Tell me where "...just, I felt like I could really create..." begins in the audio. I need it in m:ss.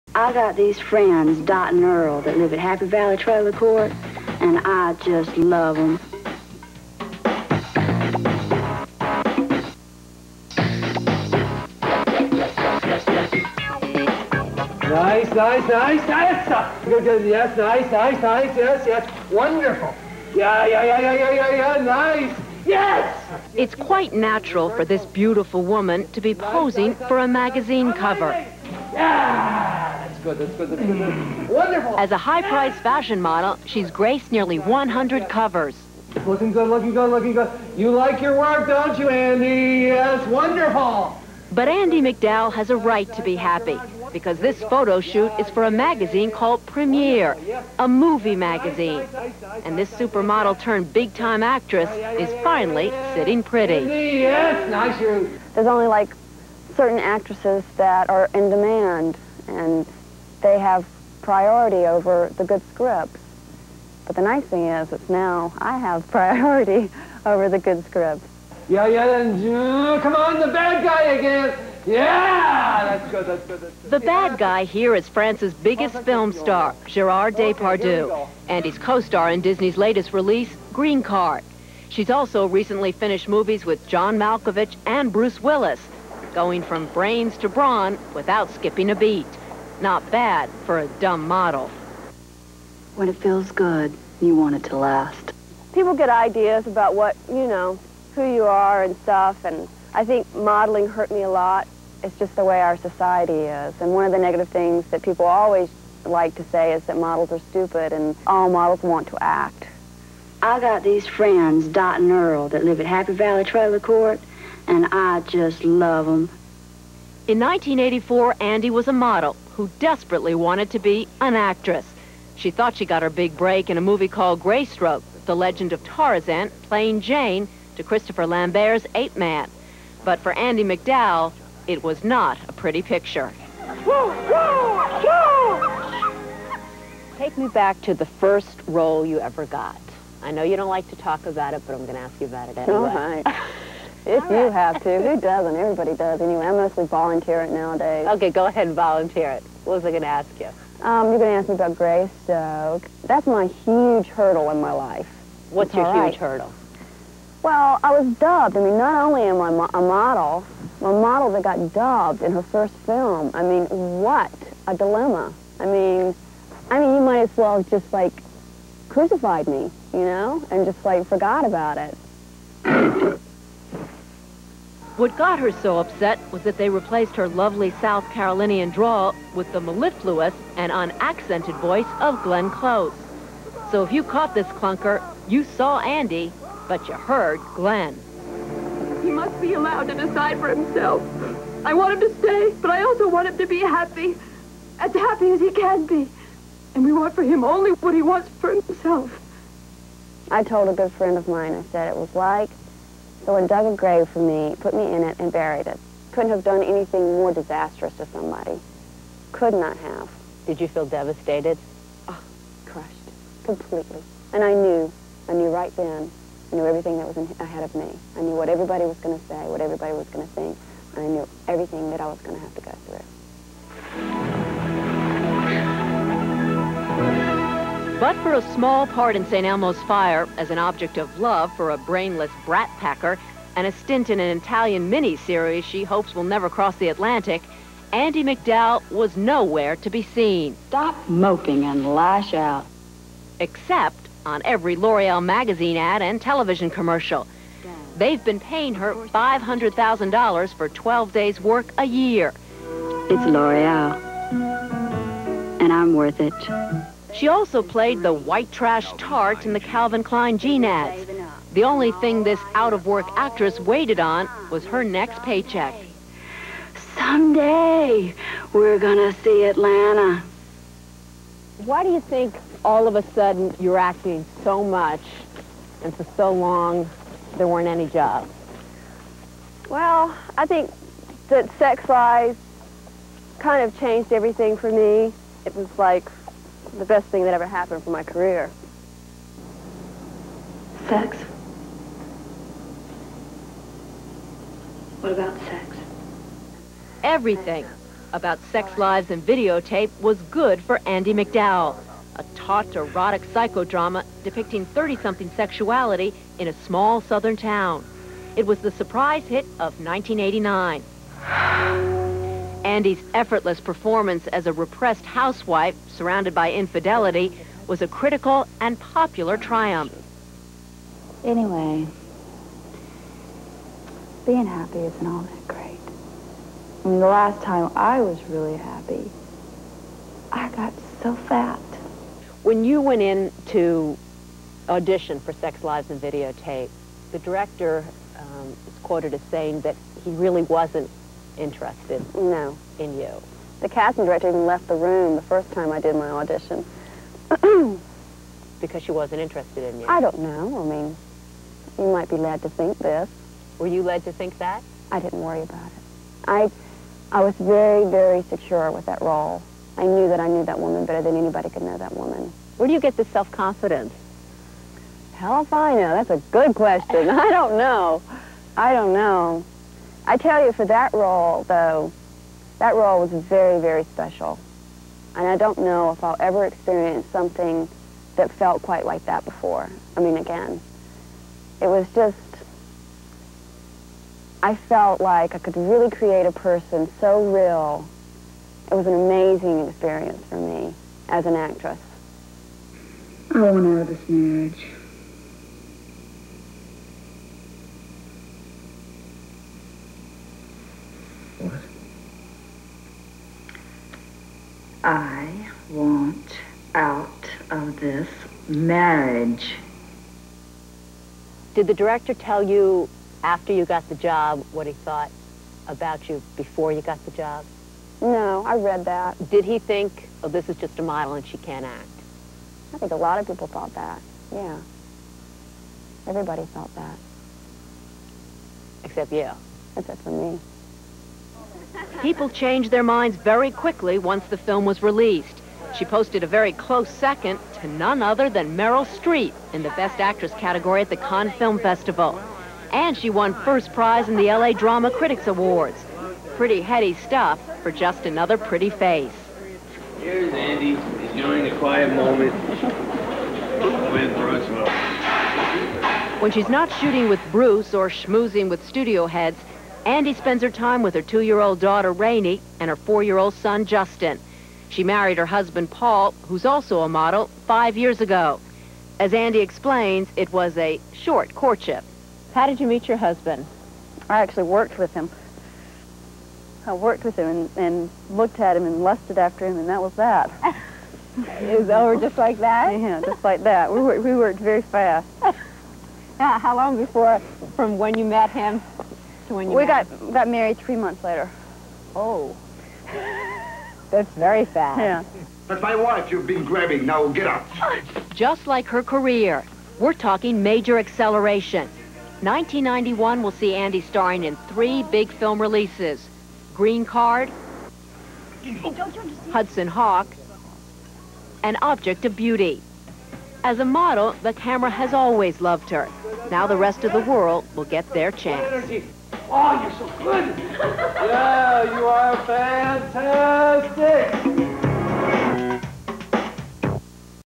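6:21.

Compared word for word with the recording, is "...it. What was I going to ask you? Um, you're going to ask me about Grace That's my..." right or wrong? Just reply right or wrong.
right.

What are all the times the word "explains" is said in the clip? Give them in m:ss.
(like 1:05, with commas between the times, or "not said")
7:49.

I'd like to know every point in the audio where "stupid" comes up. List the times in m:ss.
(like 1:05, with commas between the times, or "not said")
1:47.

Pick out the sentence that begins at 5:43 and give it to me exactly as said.
The casting director even left the room the first time I did my audition.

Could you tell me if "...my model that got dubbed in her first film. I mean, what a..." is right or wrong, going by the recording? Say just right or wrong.
right.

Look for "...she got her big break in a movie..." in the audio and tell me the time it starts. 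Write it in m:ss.
2:02.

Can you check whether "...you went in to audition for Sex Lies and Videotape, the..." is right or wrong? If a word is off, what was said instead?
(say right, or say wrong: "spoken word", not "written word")
right.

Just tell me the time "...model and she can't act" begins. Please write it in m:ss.
7:00.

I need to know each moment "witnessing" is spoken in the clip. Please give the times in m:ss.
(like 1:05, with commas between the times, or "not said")
not said.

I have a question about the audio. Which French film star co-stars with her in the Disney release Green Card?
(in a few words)
Gerard Depardieu.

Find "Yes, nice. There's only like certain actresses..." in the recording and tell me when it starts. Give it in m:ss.
0:53.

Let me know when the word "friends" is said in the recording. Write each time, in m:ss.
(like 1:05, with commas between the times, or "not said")
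0:00, 1:51, 3:20.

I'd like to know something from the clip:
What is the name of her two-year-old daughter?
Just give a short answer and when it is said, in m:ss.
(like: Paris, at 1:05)
Rainey, at 7:41.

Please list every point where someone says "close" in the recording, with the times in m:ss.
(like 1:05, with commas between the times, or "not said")
3:02, 7:16.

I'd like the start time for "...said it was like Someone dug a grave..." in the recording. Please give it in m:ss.
3:21.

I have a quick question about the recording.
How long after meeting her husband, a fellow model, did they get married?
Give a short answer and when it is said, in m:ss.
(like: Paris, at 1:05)
3 months, at 8:10.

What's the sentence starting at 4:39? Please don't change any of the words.
Well, I think that sex lies kind of changed everything for me.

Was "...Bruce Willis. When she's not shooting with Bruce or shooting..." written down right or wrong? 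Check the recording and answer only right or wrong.
wrong.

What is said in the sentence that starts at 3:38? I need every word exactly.
I knew what everybody was going to say, what everybody was going to think.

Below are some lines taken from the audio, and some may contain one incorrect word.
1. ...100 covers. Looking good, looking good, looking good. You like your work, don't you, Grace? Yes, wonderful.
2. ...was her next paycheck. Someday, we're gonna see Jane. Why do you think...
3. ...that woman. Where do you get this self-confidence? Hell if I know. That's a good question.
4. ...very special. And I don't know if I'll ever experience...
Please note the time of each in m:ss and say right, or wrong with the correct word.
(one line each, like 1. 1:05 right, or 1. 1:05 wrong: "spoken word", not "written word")
1. 0:34 wrong: "Andie", not "Grace"
2. 4:24 wrong: "Atlanta", not "Jane"
3. 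6:01 right
4. 6:13 right.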